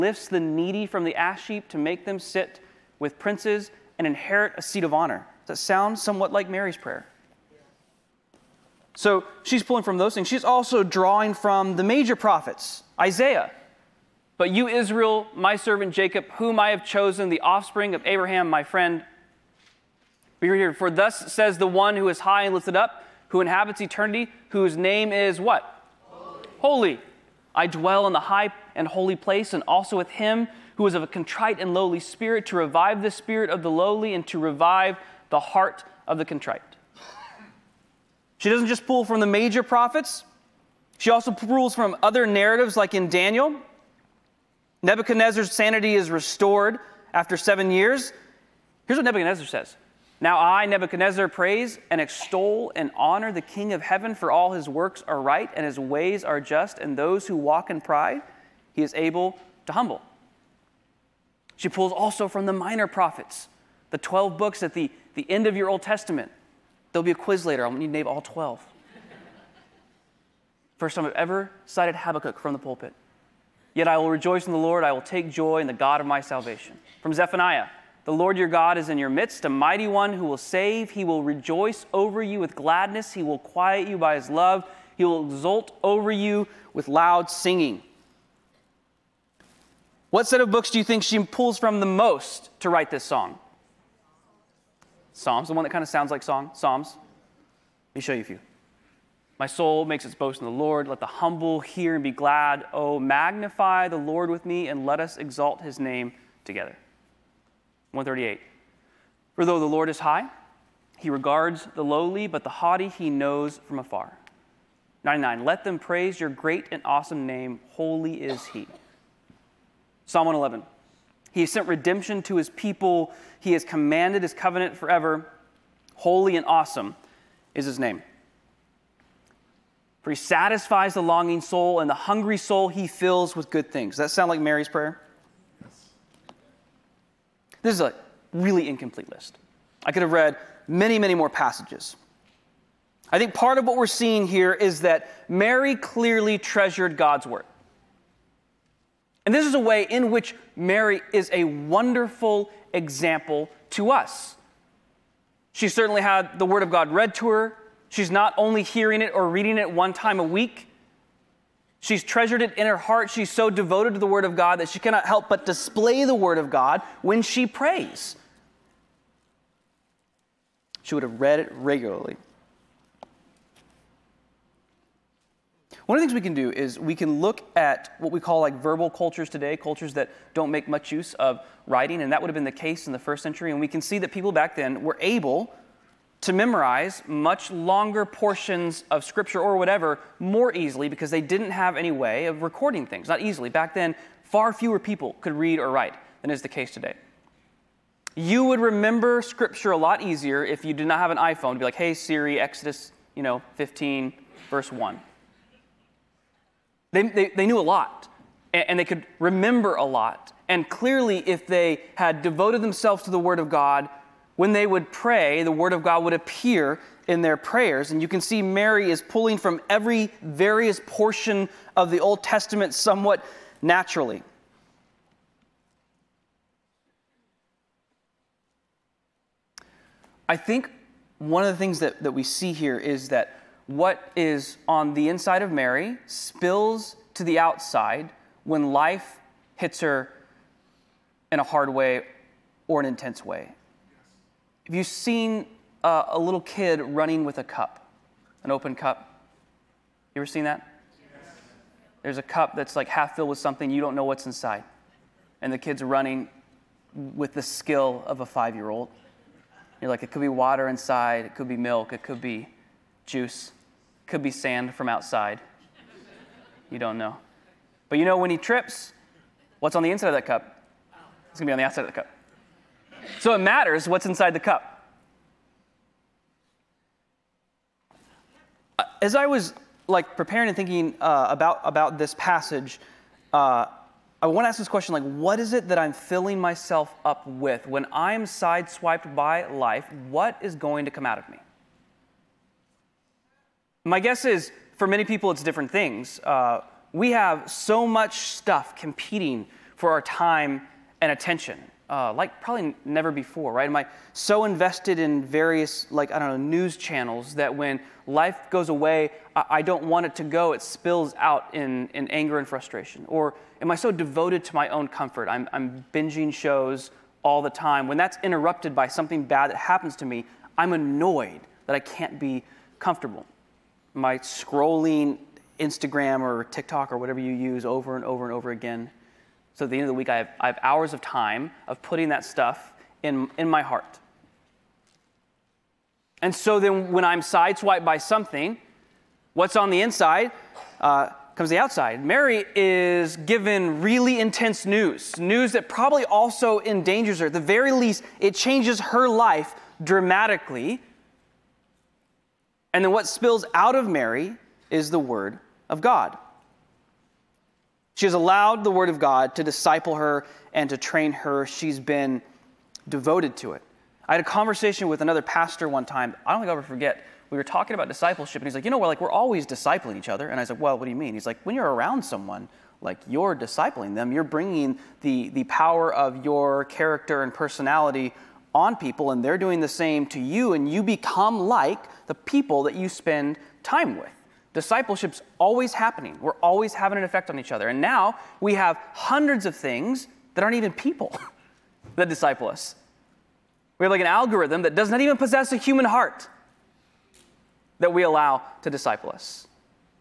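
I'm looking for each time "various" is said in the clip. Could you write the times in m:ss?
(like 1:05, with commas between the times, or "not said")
3:40, 5:05.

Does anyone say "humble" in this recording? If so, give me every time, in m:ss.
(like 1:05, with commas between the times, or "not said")
0:59, 1:41.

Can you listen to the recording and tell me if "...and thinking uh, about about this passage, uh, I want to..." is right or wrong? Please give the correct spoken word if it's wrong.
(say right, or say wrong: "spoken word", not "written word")
right.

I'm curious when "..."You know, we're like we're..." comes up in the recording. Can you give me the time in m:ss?
6:08.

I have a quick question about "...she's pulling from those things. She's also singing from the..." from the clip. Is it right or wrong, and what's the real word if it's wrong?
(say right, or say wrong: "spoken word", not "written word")
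wrong: "drawing", not "singing".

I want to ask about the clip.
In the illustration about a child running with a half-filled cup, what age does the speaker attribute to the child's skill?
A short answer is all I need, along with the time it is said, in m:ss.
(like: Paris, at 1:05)
5, at 4:18.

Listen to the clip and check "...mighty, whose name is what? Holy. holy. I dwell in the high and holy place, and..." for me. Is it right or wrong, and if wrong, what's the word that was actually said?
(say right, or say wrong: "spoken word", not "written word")
wrong: "eternity", not "mighty".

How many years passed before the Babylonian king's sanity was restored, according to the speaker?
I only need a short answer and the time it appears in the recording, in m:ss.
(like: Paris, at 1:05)
7, at 0:47.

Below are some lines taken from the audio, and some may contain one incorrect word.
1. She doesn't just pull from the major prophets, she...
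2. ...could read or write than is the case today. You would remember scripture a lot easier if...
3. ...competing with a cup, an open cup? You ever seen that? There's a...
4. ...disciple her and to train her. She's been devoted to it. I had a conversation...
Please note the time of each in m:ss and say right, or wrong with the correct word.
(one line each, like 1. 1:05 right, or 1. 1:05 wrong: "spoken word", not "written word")
1. 0:38 right
2. 3:15 right
3. 4:06 wrong: "running", not "competing"
4. 5:59 right.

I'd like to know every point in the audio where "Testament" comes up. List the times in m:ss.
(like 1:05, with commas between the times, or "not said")
1:05, 3:42.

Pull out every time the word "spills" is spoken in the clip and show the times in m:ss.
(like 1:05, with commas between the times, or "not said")
3:56, 5:10, 5:53.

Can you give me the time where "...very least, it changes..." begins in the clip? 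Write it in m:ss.
5:47.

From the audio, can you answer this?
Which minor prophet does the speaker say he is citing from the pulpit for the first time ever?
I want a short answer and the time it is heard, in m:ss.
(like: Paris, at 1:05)
Habakkuk, at 1:11.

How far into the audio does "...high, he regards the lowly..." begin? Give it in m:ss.
1:49.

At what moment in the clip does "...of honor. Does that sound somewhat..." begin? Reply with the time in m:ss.
0:04.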